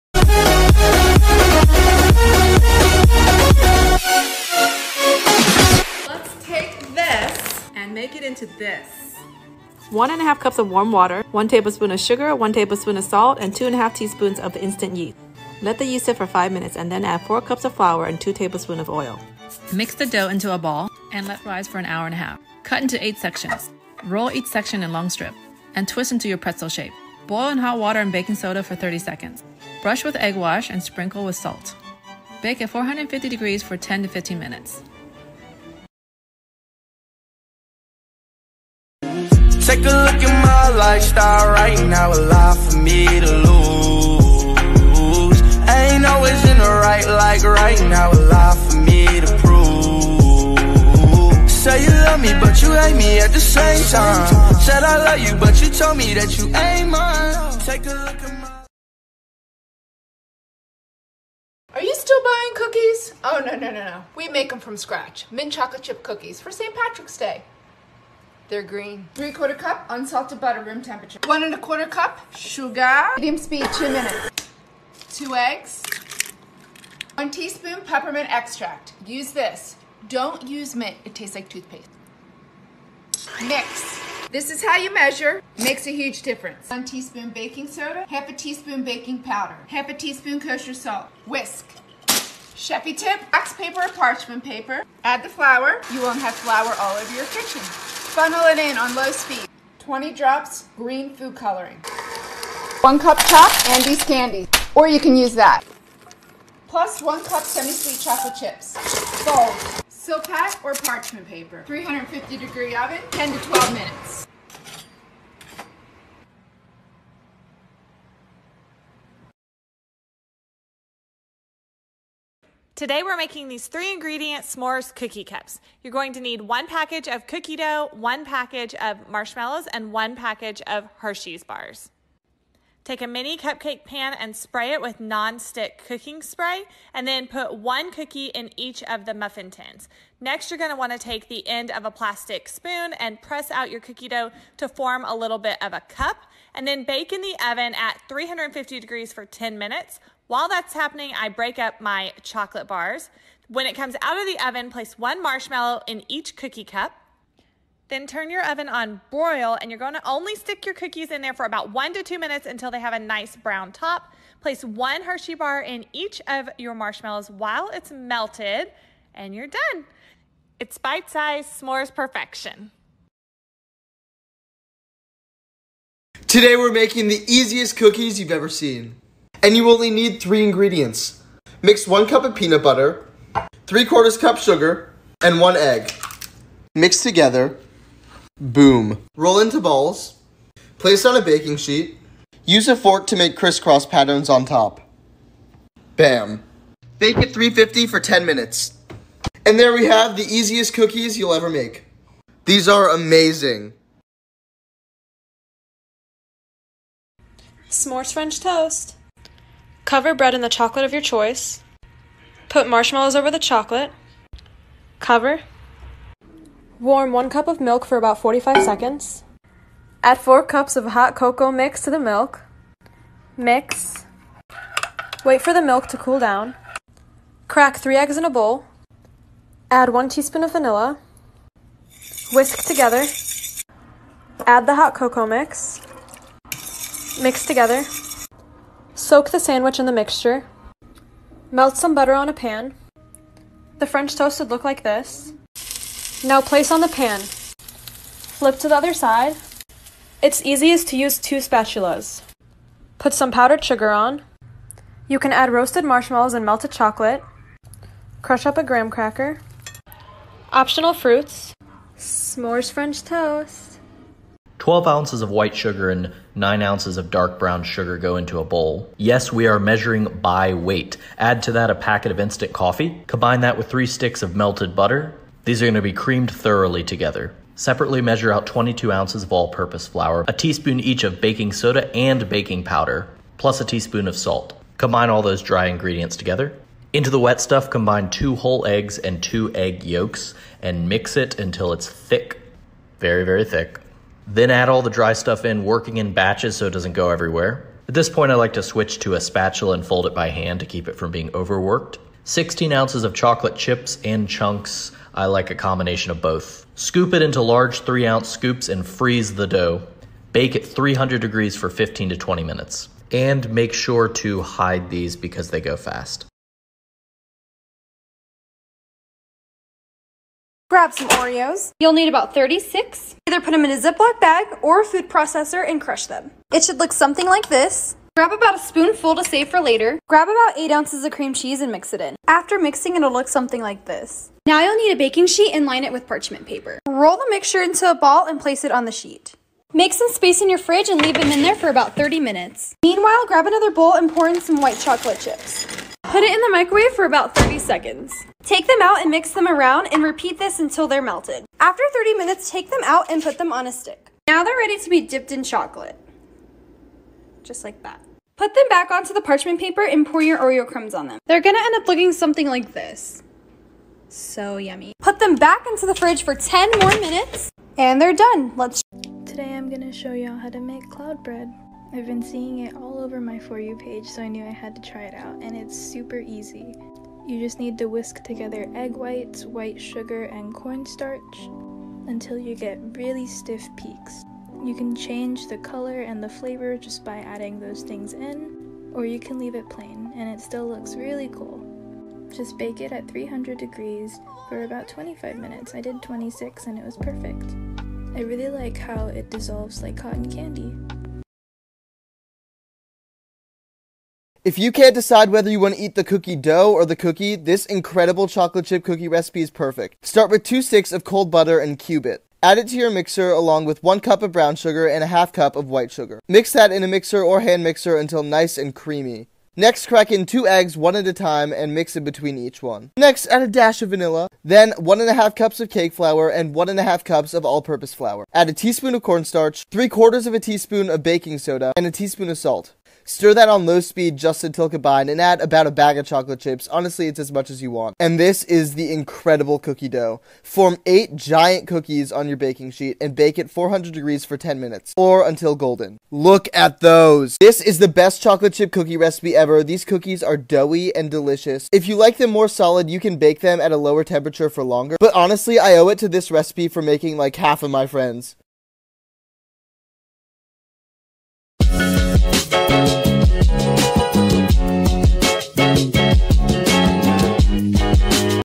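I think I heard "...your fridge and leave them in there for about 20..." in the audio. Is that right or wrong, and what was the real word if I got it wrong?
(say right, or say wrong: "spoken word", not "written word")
wrong: "30", not "20".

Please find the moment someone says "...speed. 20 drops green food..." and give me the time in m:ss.
1:39.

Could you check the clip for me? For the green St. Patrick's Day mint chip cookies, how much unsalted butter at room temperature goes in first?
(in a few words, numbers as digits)
3/4 cup.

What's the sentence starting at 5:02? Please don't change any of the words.
16 ounces of chocolate chips and chunks.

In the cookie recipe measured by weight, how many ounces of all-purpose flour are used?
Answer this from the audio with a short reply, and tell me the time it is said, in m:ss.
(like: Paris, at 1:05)
22 ounces, at 4:38.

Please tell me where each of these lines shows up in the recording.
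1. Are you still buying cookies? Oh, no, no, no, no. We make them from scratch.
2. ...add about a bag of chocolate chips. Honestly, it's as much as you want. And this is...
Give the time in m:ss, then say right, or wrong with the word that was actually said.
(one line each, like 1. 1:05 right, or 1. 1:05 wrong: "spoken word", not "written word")
1. 1:01 right
2. 7:15 right.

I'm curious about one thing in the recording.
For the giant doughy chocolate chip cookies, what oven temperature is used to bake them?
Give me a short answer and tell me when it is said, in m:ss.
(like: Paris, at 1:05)
400 degrees, at 7:23.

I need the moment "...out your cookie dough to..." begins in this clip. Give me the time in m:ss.
2:23.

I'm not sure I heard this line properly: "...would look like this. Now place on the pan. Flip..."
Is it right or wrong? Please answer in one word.
right.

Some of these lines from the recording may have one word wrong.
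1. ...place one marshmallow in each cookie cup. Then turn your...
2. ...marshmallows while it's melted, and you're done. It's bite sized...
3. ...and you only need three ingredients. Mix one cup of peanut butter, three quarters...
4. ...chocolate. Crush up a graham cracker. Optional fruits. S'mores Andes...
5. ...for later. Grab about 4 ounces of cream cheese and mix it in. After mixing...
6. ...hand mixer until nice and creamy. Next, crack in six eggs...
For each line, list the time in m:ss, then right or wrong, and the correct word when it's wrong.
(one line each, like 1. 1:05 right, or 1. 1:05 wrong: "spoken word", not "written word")
1. 2:34 right
2. 2:46 right
3. 2:59 right
4. 4:16 wrong: "French", not "Andes"
5. 5:29 wrong: "8", not "4"
6. 6:57 wrong: "two", not "six".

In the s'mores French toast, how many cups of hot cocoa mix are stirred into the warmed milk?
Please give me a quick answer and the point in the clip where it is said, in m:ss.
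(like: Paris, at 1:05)
4 cups, at 3:40.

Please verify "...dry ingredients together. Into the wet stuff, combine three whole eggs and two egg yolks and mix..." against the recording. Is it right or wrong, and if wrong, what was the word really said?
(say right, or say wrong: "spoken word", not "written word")
wrong: "two", not "three".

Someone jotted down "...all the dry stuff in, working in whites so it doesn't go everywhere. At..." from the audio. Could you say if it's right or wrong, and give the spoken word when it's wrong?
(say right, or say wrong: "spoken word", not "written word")
wrong: "batches", not "whites".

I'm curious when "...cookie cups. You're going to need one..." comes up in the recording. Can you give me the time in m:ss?
2:04.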